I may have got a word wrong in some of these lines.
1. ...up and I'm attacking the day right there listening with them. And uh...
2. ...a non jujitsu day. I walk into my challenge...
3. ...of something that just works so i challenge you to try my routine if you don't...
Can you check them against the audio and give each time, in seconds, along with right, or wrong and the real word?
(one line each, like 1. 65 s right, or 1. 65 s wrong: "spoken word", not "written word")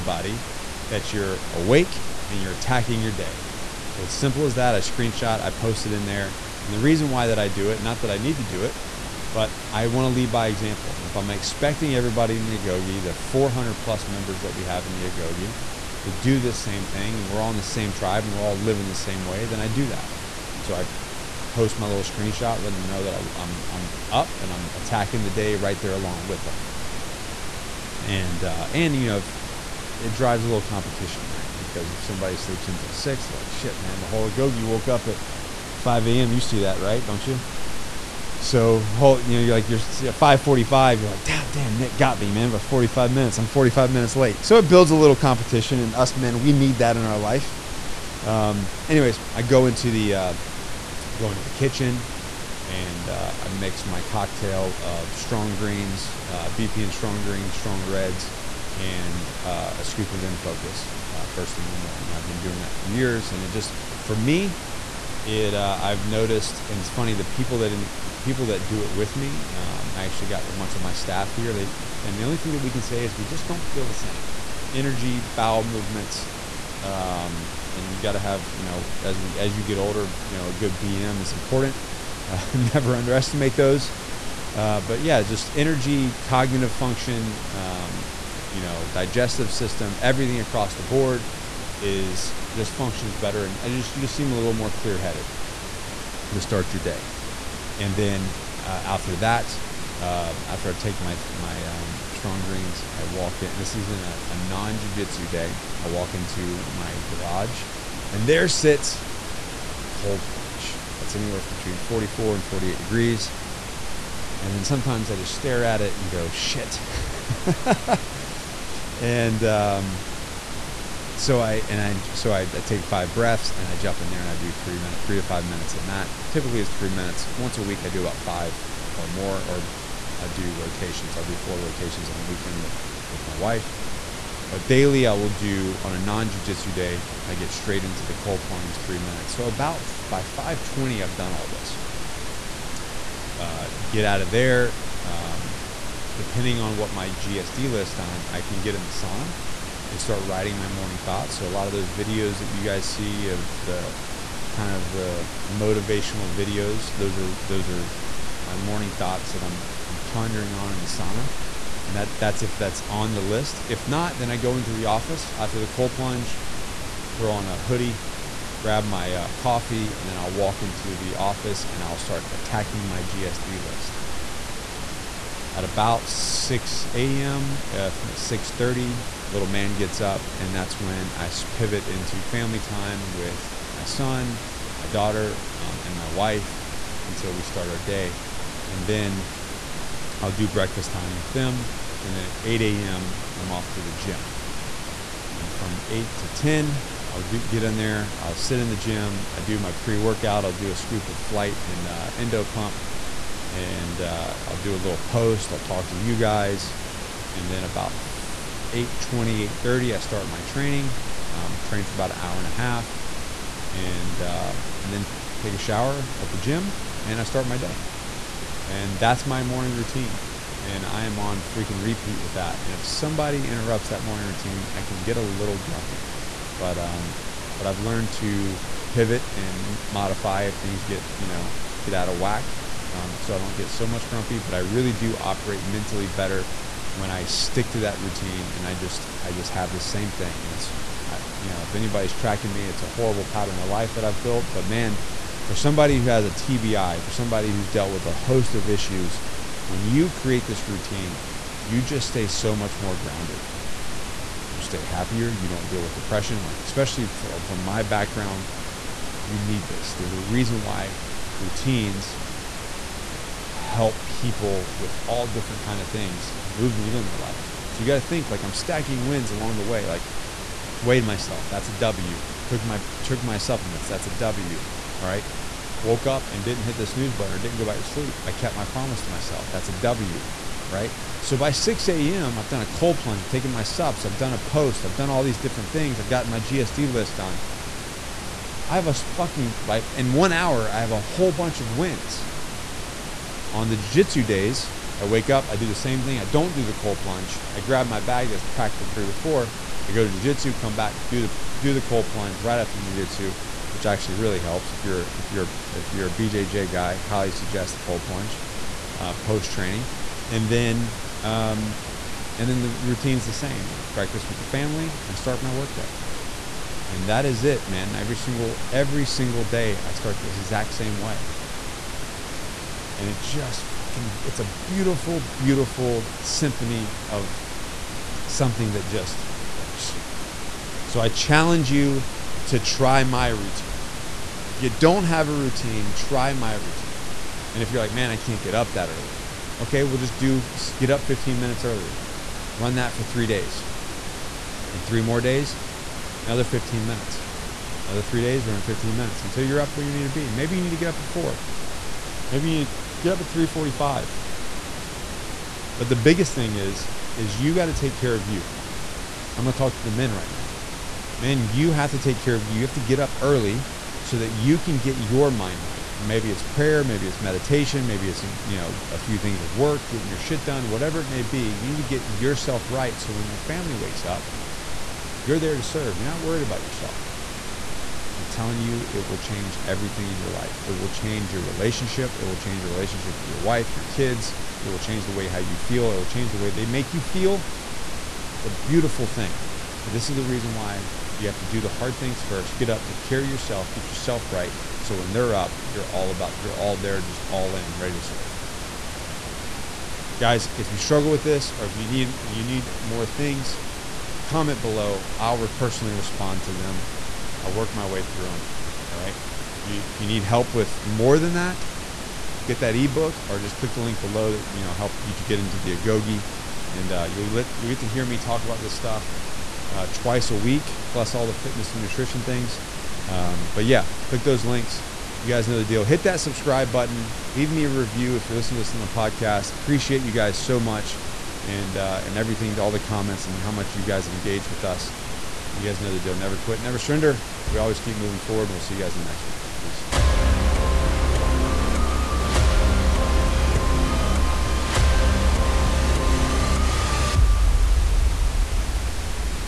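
1. 24 s wrong: "along", not "listening"
2. 104 s wrong: "garage", not "challenge"
3. 327 s right.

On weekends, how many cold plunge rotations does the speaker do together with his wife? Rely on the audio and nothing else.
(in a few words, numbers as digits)
4.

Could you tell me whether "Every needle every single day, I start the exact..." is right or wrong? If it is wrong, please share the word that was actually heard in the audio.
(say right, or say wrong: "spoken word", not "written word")
wrong: "single", not "needle".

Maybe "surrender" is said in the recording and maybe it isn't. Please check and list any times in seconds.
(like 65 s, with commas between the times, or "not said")
436 s.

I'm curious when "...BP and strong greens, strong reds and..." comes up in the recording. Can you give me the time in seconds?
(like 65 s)
56 s.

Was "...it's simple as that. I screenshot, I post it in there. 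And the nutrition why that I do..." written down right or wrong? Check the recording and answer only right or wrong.
wrong.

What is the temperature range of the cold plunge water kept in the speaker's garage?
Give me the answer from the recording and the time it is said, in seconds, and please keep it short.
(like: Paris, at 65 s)
44 to 48 degrees, at 111 s.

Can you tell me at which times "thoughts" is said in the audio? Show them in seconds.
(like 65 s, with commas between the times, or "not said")
150 s, 158 s.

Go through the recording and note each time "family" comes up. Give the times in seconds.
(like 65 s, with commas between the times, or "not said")
182 s, 314 s, 373 s.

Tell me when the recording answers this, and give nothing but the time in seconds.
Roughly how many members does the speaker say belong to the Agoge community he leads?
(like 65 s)
13 s.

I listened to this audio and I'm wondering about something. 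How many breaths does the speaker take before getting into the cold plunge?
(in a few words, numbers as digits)
5.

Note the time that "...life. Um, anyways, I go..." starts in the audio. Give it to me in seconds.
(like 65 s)
47 s.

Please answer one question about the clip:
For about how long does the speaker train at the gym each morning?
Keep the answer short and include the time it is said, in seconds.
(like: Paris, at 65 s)
an hour and a half, at 211 s.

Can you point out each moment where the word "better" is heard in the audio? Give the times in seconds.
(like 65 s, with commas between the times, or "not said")
93 s, 236 s.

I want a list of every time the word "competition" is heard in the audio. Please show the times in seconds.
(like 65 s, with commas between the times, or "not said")
30 s, 45 s.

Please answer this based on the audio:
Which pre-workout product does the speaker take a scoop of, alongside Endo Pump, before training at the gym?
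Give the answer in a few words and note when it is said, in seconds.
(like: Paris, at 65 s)
Flight, at 200 s.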